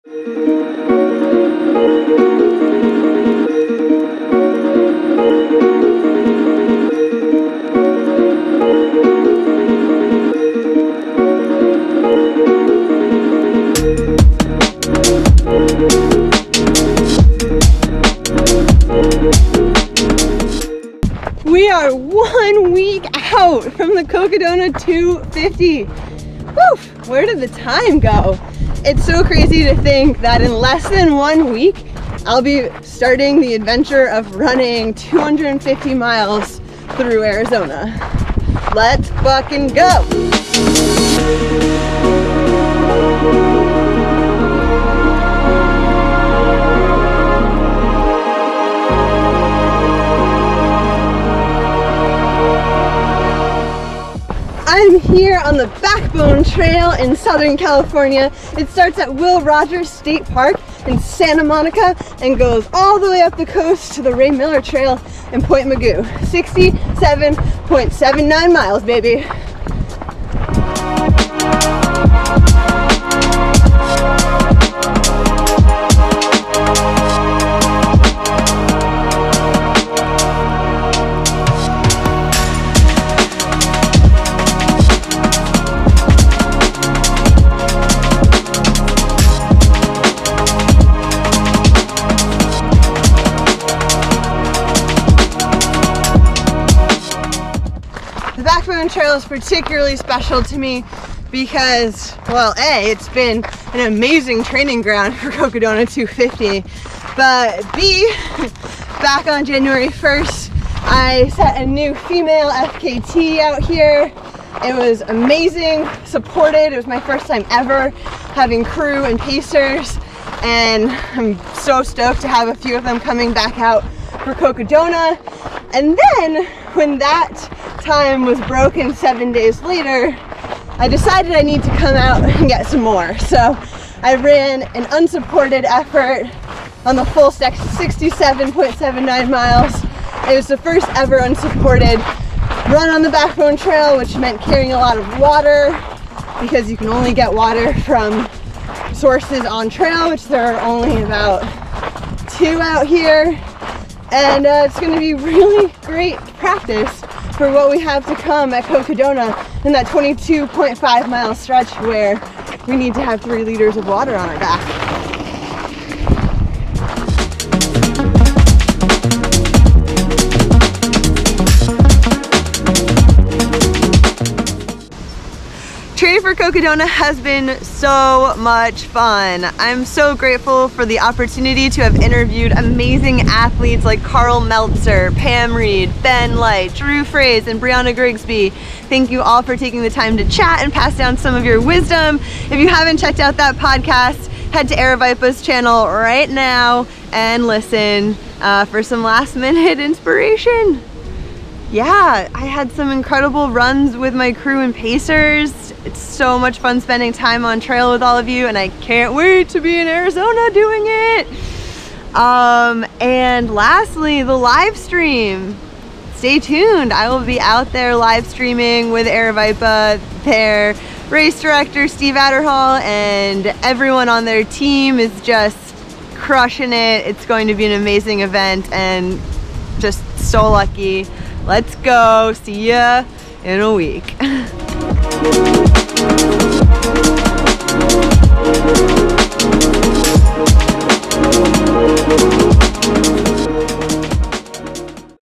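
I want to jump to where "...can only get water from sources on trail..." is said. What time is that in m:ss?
2:26.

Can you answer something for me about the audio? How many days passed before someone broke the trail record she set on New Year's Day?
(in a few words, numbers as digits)
7.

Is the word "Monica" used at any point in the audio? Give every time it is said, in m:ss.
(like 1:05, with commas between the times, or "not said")
1:01.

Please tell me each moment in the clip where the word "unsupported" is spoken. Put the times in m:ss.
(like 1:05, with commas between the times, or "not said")
2:14, 2:21.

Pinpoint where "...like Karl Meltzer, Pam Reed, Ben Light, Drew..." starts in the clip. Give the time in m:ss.
3:03.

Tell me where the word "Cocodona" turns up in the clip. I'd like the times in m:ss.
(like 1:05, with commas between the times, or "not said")
0:24, 1:45, 2:04, 2:38, 2:56.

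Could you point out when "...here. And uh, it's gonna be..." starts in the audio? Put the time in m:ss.
2:32.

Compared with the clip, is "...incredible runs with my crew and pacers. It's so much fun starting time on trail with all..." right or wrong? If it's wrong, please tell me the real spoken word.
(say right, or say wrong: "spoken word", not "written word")
wrong: "spending", not "starting".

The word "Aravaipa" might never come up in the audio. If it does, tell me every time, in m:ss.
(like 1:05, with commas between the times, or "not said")
3:14, 3:39.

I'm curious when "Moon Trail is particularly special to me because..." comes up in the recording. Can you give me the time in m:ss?
1:38.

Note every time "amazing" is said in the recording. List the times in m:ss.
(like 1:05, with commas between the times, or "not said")
1:43, 1:55, 3:02, 3:47.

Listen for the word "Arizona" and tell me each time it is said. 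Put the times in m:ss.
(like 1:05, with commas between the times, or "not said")
0:37, 3:29.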